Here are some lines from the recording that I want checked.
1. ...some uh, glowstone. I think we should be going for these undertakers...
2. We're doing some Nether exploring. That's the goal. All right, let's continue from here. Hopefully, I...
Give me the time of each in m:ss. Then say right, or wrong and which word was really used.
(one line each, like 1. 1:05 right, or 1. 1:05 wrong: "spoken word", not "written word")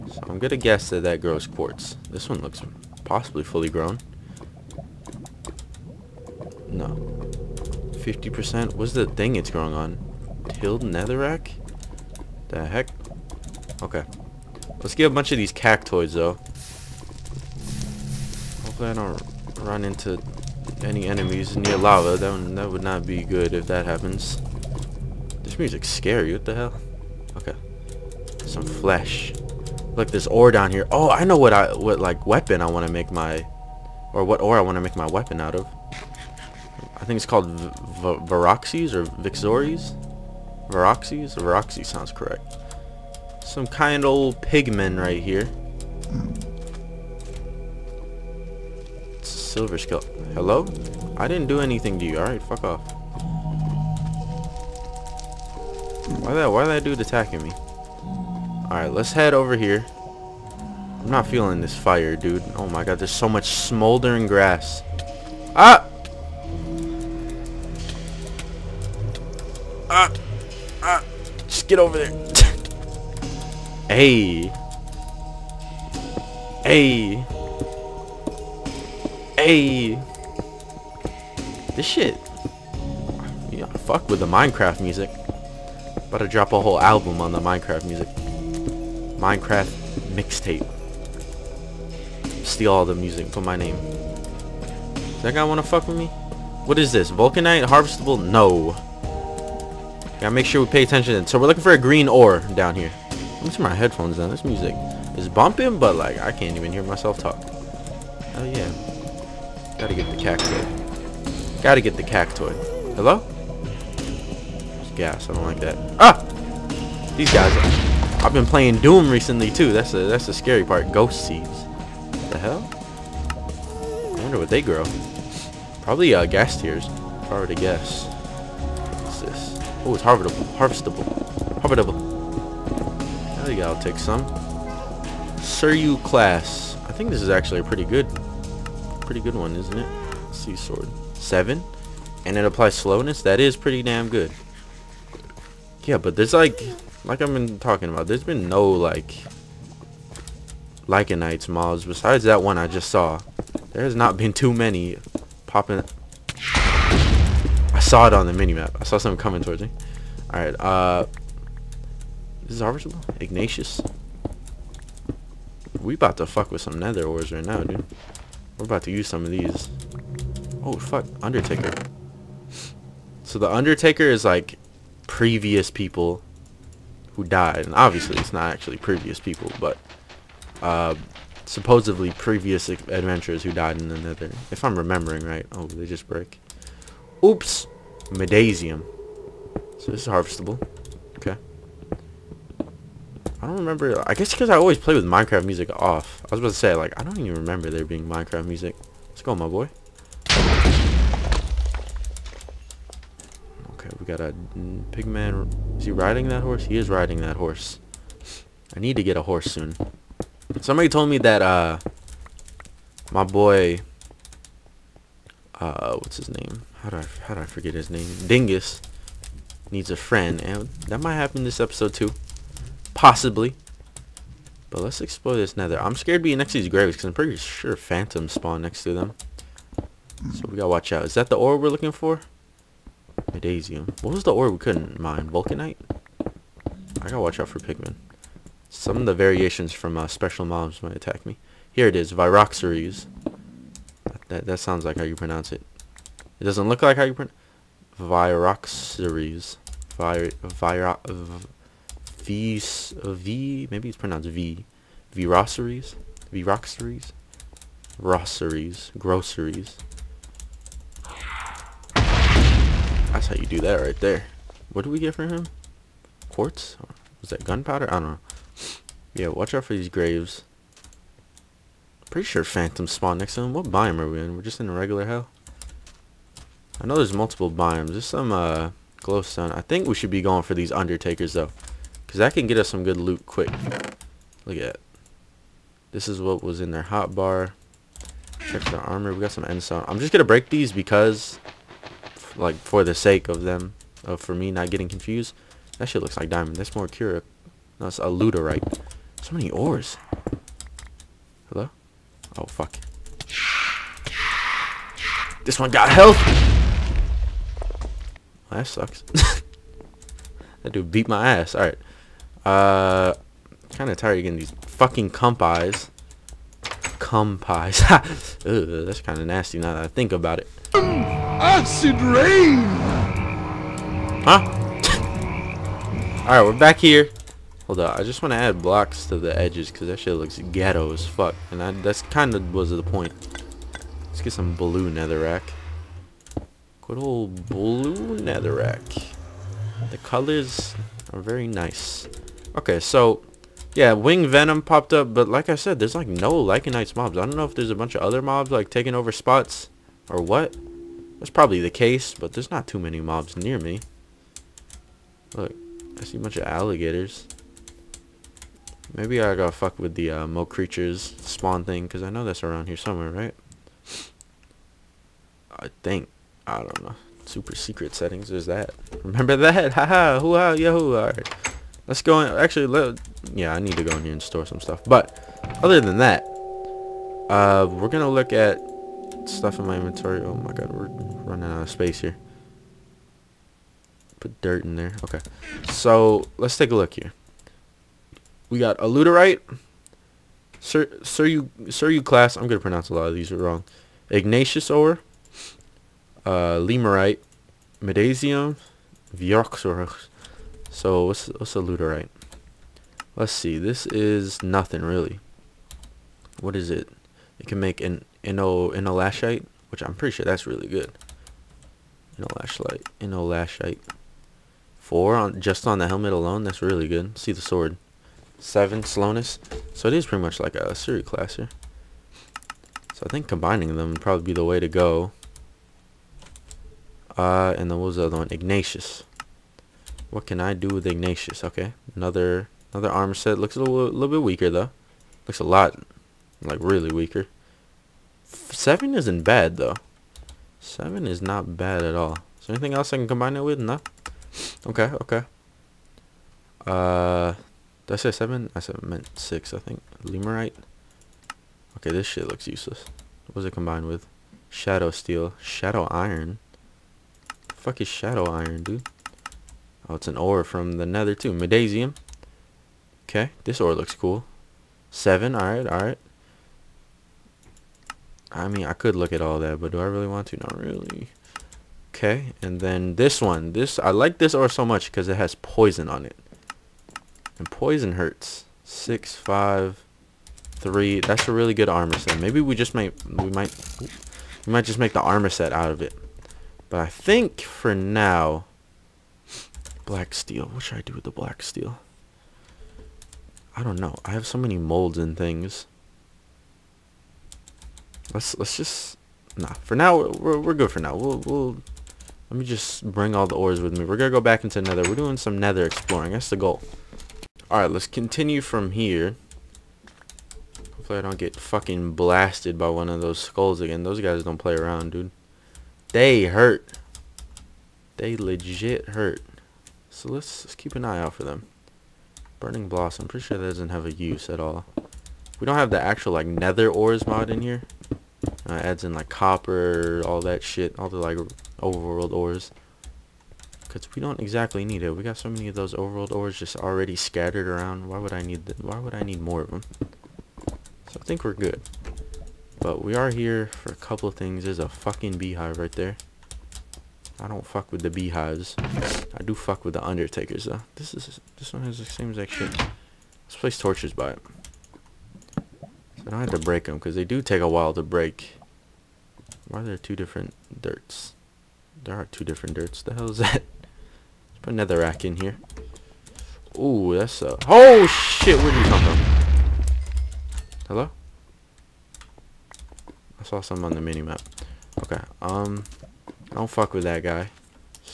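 1. 4:38 right
2. 8:24 right.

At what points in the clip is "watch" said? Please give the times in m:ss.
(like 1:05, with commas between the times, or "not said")
3:50, 3:57, 4:29.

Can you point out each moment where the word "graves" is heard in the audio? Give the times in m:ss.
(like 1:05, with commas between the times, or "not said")
3:46, 4:29.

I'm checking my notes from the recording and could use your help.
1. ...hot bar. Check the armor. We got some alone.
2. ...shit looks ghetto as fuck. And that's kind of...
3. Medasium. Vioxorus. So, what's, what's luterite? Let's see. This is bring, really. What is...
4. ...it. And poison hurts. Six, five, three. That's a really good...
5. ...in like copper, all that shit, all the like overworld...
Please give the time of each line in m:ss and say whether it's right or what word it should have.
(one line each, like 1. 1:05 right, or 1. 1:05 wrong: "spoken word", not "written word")
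1. 4:46 wrong: "endstone", not "alone"
2. 5:30 right
3. 6:37 wrong: "nothing", not "bring"
4. 7:56 right
5. 8:48 right.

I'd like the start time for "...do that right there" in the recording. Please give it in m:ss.
4:23.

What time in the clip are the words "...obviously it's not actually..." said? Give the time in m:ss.
2:57.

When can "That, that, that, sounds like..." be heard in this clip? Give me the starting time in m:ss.
4:04.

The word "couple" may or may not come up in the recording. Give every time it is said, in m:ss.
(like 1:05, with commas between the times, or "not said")
9:03.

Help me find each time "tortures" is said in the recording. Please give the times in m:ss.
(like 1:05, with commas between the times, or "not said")
9:13.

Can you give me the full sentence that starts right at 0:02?
This one looks possibly fully grown.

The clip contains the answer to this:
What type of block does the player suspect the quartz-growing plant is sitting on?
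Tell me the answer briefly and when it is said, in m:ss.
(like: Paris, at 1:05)
Tilled netherrack, at 0:10.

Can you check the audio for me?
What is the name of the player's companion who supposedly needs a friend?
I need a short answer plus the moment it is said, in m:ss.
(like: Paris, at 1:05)
Dingus, at 3:38.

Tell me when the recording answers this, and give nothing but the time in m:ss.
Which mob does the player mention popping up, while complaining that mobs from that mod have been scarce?
5:43.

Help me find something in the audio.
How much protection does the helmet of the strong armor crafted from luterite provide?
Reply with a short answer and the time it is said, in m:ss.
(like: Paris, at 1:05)
4, at 6:54.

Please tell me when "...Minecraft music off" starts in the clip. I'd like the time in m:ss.
3:15.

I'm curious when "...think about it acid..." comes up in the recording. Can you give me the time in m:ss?
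5:19.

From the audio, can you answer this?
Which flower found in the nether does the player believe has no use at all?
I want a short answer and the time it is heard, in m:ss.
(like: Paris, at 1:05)
Burning Blossom, at 8:42.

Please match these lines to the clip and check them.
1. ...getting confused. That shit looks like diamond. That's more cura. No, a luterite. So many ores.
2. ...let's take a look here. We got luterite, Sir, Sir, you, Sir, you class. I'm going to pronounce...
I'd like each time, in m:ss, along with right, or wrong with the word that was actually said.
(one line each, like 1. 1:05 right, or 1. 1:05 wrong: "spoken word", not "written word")
1. 4:54 right
2. 6:26 right.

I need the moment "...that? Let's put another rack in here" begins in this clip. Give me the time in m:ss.
9:23.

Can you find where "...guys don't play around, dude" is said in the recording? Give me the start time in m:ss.
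8:34.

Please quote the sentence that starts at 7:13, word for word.
Looks a little, little bit weaker though.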